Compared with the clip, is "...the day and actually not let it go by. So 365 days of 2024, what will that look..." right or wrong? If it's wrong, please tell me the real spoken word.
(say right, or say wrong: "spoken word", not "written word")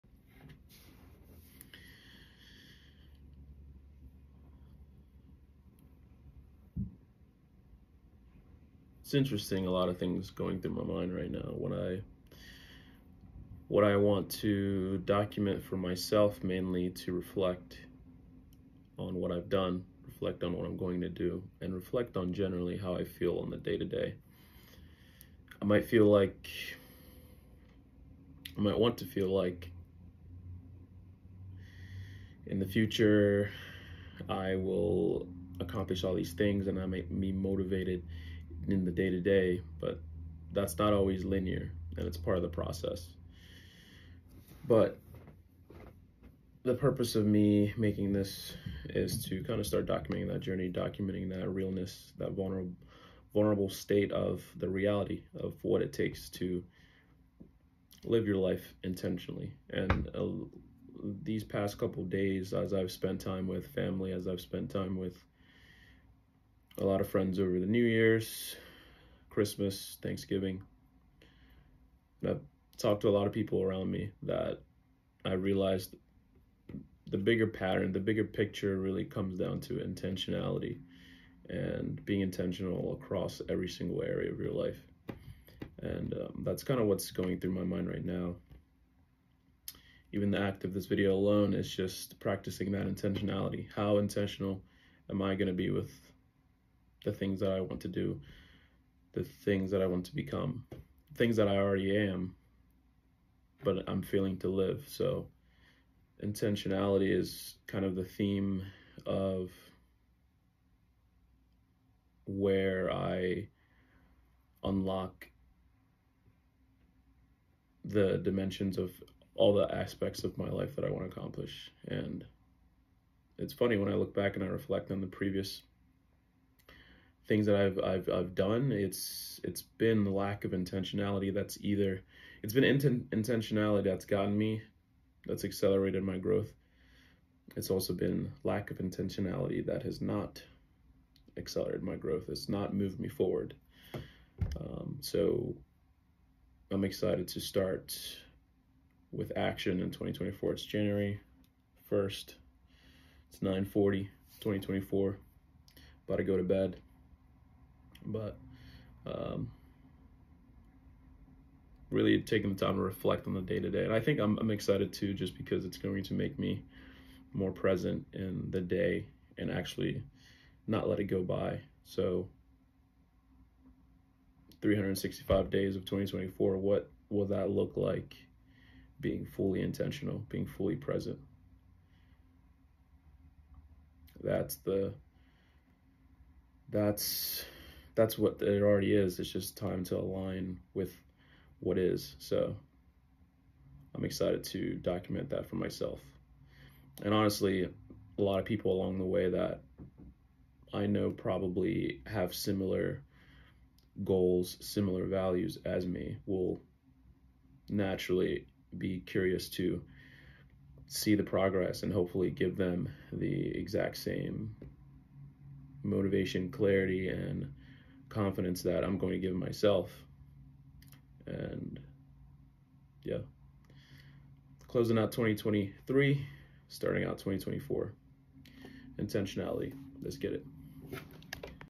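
right.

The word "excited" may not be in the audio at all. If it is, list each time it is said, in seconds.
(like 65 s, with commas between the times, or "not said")
146 s, 164 s, 194 s.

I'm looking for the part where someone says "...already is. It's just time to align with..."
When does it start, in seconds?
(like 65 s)
188 s.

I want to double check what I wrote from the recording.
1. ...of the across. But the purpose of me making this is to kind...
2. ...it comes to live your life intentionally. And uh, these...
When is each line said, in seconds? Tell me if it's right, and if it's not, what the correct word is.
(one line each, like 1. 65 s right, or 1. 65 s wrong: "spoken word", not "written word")
1. 42 s wrong: "process", not "across"
2. 55 s wrong: "takes", not "comes".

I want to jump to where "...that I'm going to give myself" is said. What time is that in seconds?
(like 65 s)
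218 s.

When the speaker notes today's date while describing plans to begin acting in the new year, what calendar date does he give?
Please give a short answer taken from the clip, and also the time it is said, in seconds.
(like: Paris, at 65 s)
January 1st, at 150 s.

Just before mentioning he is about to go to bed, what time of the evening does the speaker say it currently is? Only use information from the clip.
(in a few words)
9:40.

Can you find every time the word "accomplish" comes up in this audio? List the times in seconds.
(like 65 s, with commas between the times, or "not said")
35 s, 121 s.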